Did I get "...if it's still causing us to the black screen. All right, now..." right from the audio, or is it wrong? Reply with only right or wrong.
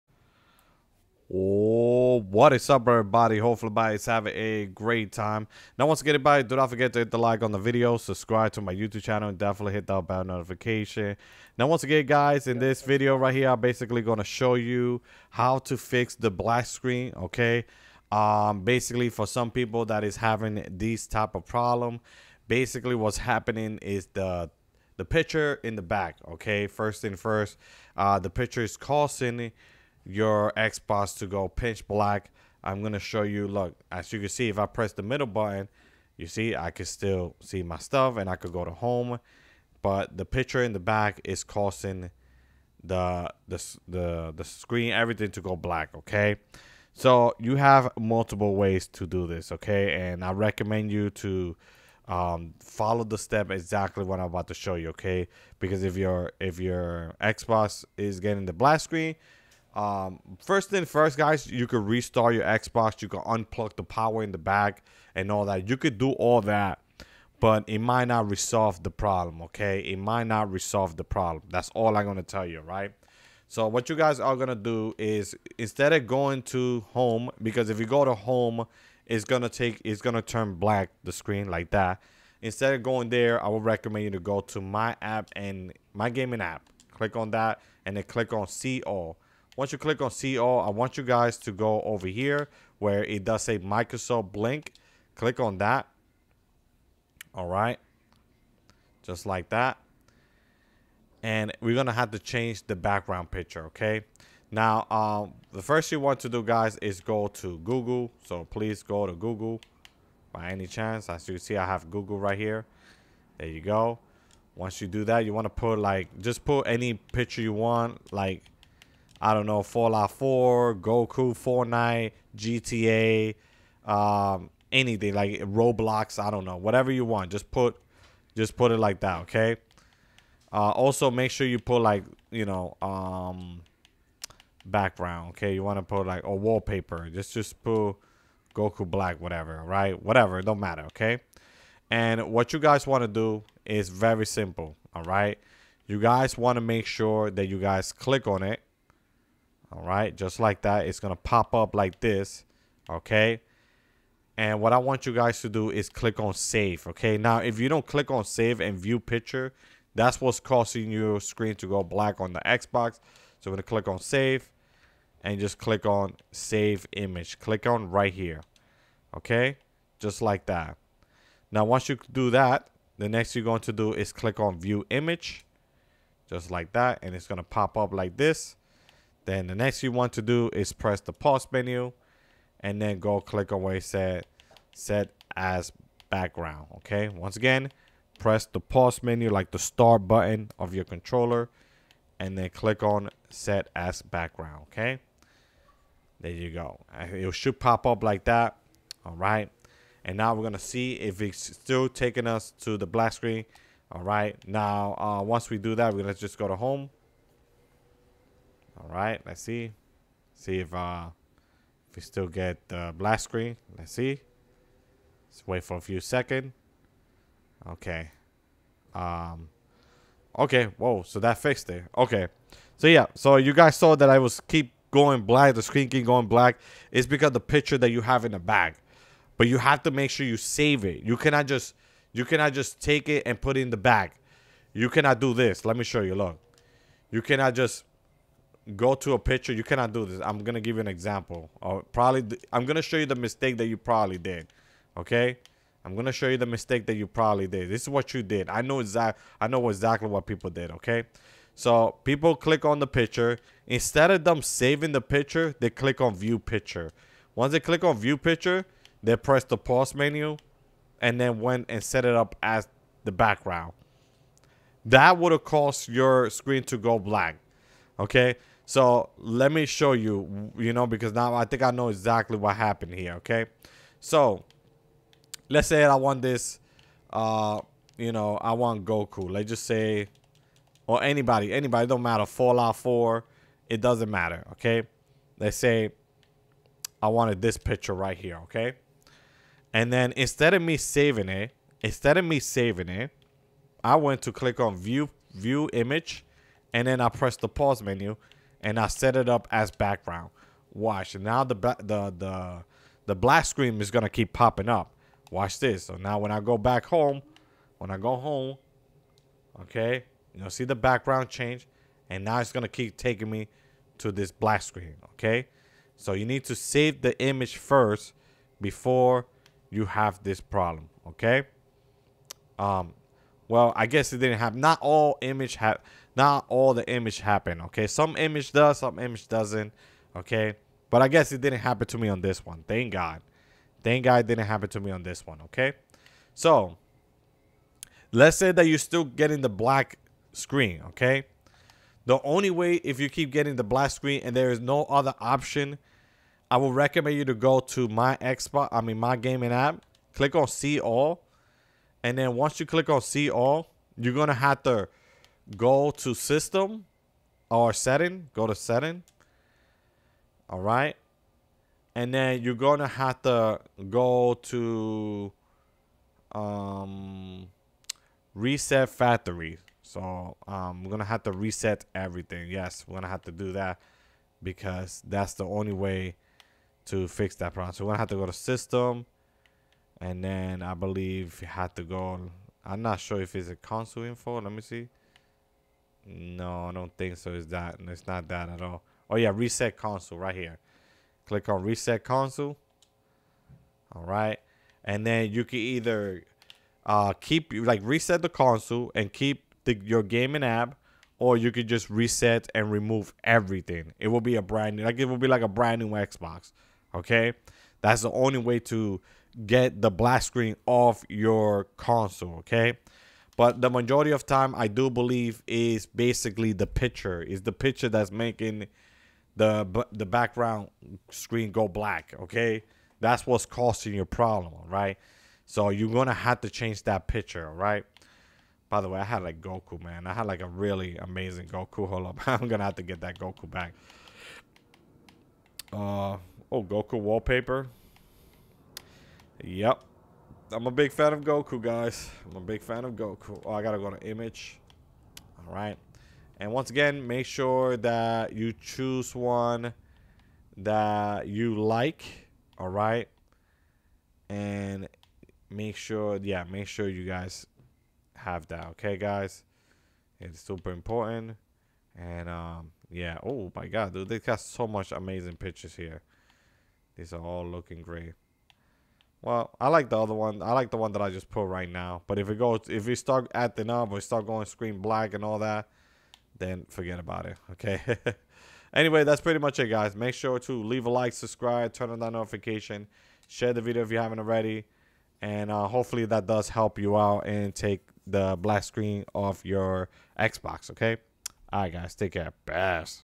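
wrong.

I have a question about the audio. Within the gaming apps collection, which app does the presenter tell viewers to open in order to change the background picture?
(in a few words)
Microsoft Blink.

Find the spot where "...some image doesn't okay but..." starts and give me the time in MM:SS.
05:28.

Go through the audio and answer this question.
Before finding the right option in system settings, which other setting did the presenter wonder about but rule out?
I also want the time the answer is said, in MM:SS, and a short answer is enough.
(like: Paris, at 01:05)
console info, at 06:23.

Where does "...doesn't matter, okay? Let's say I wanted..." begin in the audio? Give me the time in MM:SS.
04:43.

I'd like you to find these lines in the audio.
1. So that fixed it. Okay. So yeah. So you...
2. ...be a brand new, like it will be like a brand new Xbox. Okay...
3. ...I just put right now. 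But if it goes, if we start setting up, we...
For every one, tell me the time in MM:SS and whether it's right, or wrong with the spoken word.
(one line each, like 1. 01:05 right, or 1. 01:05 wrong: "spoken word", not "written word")
1. 03:41 right
2. 06:44 right
3. 07:51 wrong: "acting", not "setting".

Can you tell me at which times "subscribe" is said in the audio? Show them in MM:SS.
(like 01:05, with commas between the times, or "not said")
00:07, 08:01.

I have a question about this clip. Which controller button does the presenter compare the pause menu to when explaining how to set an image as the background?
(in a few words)
star button.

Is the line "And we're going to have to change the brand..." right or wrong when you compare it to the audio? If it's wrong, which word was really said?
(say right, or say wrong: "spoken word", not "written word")
wrong: "background", not "brand".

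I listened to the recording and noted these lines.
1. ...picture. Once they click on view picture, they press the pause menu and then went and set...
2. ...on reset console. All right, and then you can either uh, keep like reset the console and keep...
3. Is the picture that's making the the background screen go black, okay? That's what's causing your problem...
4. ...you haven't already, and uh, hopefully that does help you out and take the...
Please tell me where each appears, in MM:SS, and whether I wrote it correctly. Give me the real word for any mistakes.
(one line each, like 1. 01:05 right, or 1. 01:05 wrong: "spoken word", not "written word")
1. 04:16 right
2. 06:31 right
3. 06:57 right
4. 08:03 right.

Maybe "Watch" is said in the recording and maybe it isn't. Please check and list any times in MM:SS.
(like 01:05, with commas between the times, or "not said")
05:00, 05:05.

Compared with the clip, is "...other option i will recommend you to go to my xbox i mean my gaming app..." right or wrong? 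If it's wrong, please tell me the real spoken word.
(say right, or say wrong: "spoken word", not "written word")
right.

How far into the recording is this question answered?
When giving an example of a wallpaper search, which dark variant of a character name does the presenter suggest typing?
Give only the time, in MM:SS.
02:18.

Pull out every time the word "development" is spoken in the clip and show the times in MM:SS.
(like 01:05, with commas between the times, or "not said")
not said.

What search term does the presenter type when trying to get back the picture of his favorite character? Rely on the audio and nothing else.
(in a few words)
Goku wallpaper.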